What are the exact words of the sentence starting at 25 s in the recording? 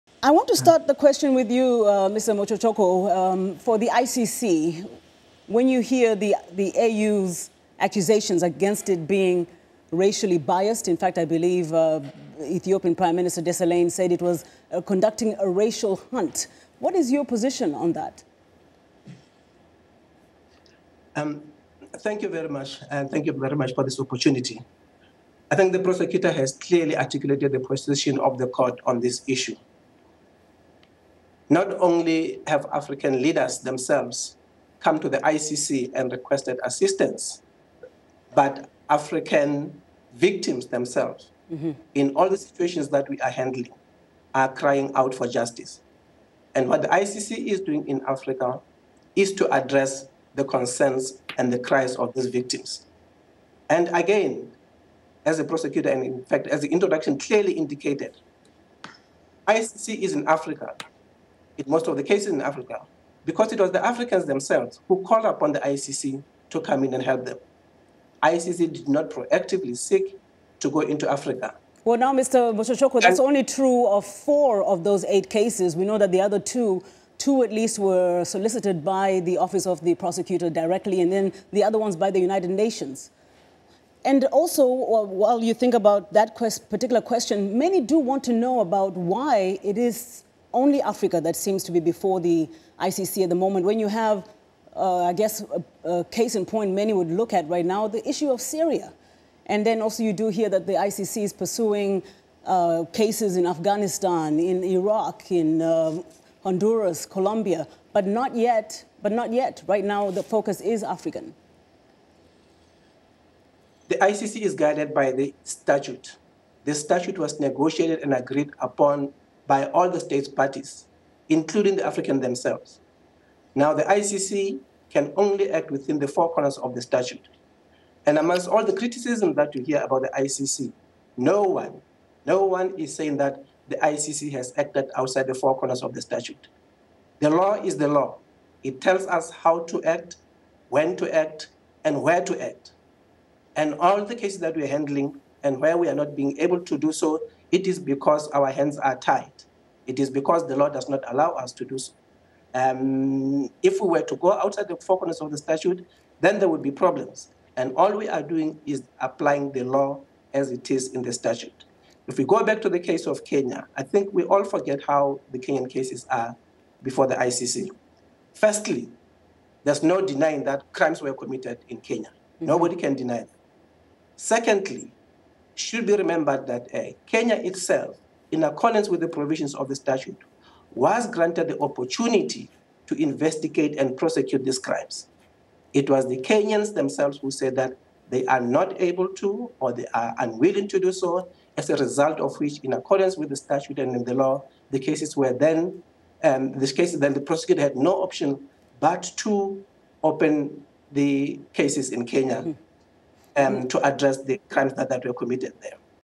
I think the prosecutor has clearly articulated the position of the court on this issue.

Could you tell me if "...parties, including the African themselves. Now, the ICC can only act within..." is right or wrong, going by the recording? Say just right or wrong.
right.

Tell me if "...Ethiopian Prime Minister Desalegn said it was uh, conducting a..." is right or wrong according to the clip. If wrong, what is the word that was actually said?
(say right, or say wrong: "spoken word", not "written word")
right.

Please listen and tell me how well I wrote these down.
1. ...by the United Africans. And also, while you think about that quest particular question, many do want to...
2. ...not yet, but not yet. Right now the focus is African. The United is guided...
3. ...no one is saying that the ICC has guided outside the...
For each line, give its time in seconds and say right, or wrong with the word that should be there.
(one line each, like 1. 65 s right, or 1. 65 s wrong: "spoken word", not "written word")
1. 81 s wrong: "Nations", not "Africans"
2. 108 s wrong: "ICC", not "United"
3. 132 s wrong: "acted", not "guided".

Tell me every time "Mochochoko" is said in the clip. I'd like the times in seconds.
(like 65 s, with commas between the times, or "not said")
2 s, 72 s.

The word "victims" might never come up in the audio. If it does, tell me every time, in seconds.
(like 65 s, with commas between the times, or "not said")
40 s, 52 s.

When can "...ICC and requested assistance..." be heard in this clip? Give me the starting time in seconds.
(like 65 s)
35 s.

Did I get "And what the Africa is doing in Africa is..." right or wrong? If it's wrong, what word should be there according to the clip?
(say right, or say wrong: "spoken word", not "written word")
wrong: "ICC", not "Africa".